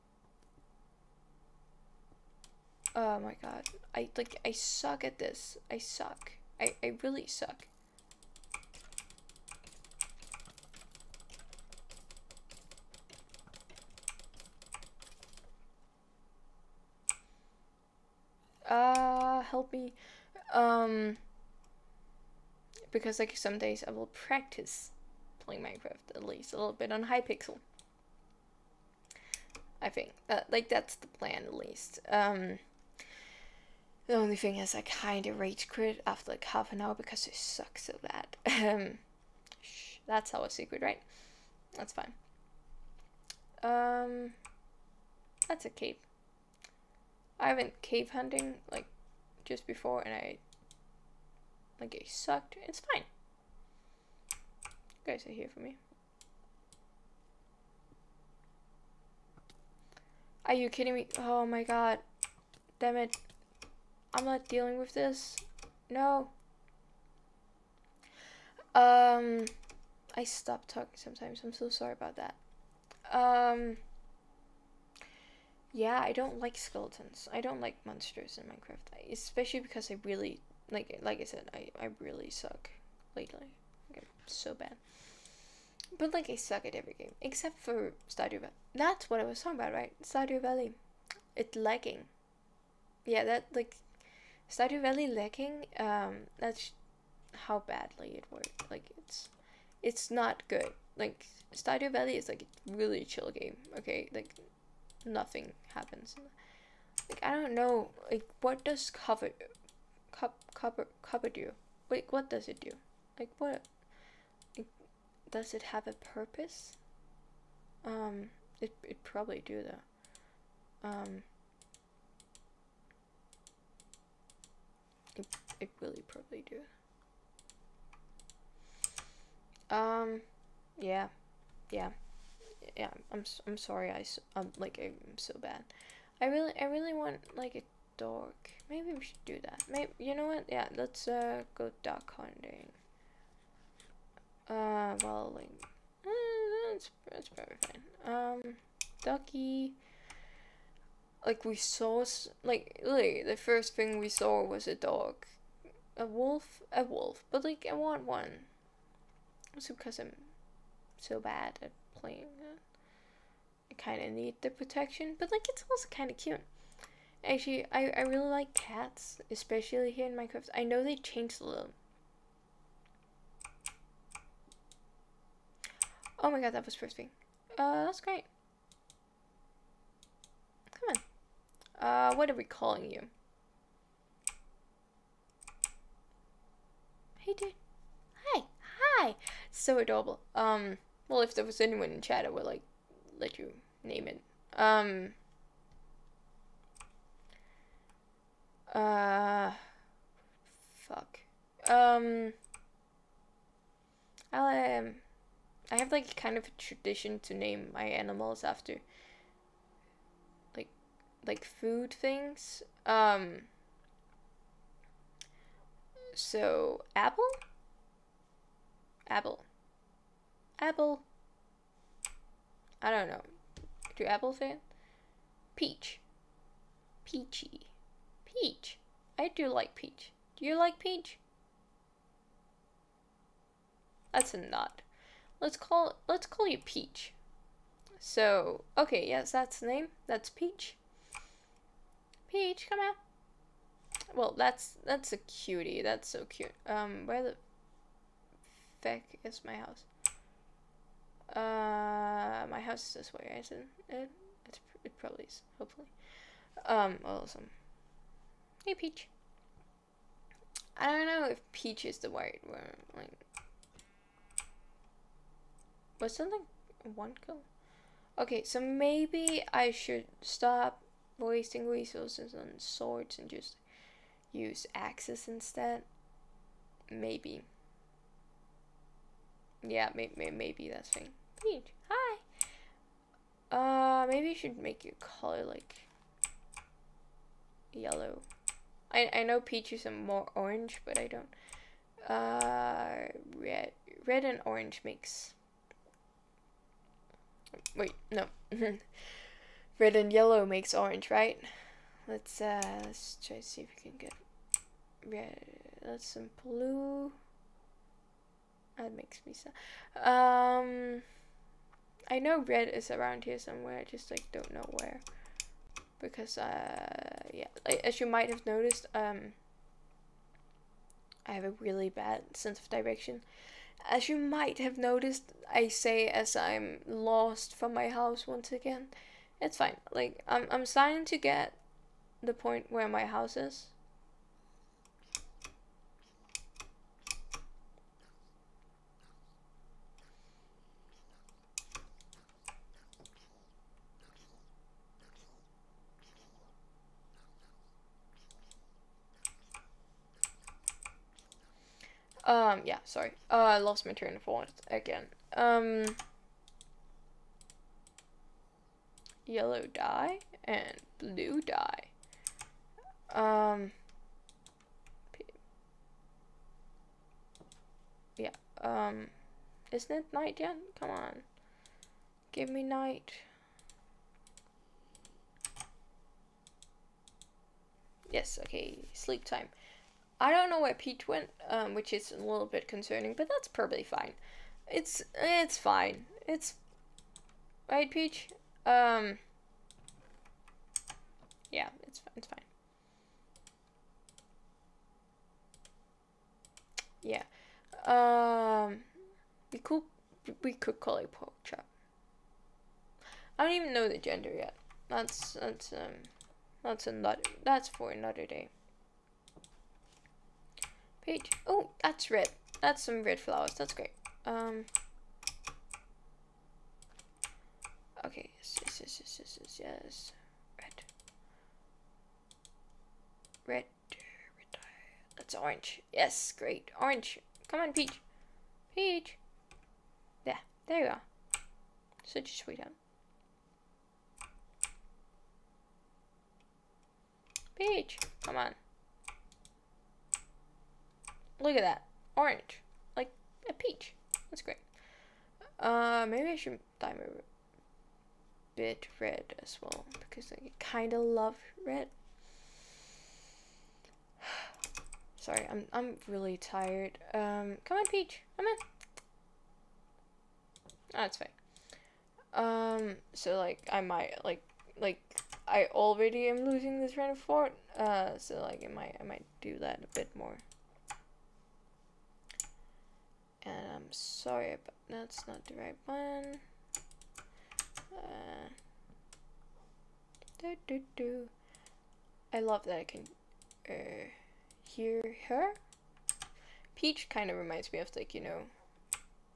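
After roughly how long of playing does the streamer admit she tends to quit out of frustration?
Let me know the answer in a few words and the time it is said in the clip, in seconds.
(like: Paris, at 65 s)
half an hour, at 36 s.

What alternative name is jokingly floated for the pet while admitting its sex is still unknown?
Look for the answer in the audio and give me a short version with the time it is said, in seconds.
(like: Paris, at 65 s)
Pork Chop, at 401 s.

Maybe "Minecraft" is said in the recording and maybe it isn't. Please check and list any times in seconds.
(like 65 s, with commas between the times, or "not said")
25 s, 78 s, 170 s.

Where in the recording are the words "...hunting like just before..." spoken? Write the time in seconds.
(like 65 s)
48 s.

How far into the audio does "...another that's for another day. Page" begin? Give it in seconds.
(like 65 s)
406 s.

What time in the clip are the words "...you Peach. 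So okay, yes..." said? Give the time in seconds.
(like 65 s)
236 s.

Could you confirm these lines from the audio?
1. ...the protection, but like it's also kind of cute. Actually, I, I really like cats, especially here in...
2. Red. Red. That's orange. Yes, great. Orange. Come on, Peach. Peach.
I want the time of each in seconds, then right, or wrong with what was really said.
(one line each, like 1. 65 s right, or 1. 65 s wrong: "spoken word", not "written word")
1. 164 s right
2. 423 s right.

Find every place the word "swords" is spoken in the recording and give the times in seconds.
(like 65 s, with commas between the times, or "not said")
272 s.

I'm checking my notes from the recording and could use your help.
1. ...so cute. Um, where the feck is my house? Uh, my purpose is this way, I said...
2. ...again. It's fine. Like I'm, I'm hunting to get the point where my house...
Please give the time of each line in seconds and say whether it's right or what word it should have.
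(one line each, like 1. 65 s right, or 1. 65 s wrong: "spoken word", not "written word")
1. 246 s wrong: "house", not "purpose"
2. 328 s wrong: "starting", not "hunting".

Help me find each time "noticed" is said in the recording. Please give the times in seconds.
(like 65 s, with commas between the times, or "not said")
318 s, 324 s.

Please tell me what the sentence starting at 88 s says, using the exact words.
That's what I was talking about, right?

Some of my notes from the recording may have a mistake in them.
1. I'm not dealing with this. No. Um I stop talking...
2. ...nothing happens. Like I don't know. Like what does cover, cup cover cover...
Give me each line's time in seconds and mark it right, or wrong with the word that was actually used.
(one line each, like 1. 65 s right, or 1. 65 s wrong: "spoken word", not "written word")
1. 64 s right
2. 105 s right.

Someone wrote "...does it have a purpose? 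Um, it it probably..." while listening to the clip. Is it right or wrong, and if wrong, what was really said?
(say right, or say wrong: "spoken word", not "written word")
right.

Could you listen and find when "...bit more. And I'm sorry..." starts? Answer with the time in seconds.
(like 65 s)
469 s.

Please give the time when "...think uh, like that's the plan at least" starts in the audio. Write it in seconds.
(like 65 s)
29 s.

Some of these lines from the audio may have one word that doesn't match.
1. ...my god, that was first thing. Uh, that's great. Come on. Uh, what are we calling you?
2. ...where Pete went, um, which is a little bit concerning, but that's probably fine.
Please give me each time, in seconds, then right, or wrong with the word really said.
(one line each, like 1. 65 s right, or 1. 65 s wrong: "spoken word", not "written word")
1. 176 s right
2. 380 s right.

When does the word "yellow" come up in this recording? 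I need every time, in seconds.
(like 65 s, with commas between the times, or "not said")
287 s, 300 s, 359 s.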